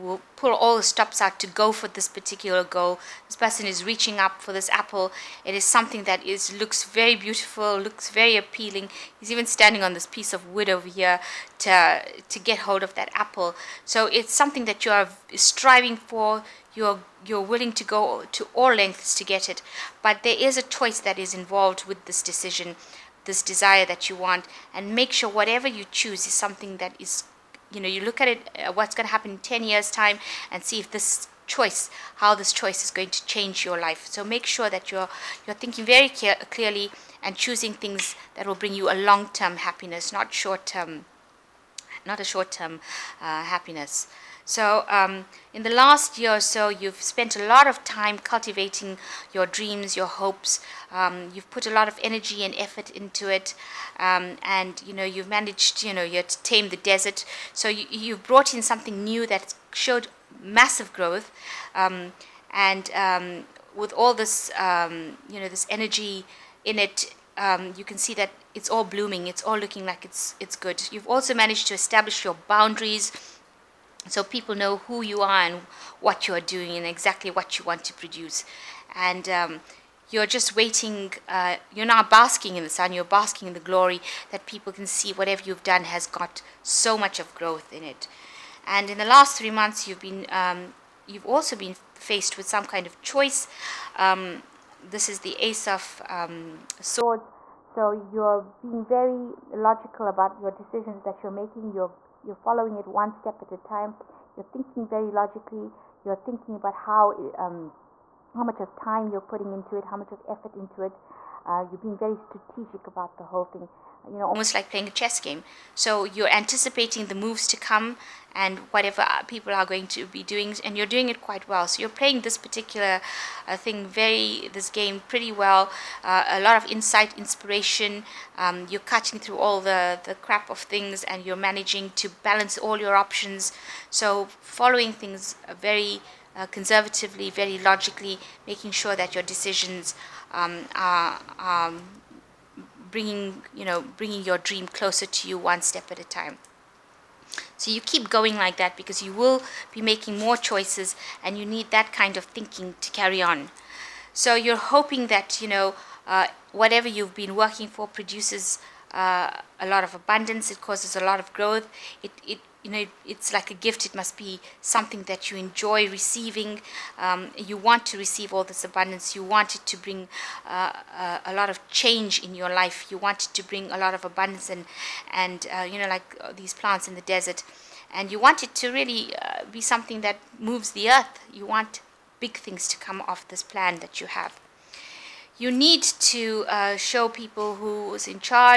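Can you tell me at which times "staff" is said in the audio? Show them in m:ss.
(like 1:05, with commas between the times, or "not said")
not said.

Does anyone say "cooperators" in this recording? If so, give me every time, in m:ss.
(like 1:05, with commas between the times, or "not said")
not said.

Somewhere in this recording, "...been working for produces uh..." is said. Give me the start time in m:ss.
2:37.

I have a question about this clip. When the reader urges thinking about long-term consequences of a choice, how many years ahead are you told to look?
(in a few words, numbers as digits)
10.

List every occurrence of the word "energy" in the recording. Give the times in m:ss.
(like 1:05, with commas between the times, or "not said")
0:52, 1:05.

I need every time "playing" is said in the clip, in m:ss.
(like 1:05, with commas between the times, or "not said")
1:54, 2:02.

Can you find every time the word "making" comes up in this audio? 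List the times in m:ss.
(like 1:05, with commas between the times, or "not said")
1:41, 2:18, 2:29.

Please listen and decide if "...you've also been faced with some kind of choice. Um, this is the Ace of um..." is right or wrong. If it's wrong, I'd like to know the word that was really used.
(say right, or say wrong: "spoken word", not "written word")
right.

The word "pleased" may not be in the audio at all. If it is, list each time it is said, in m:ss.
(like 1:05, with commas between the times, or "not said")
not said.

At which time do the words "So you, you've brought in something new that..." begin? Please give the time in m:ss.
0:57.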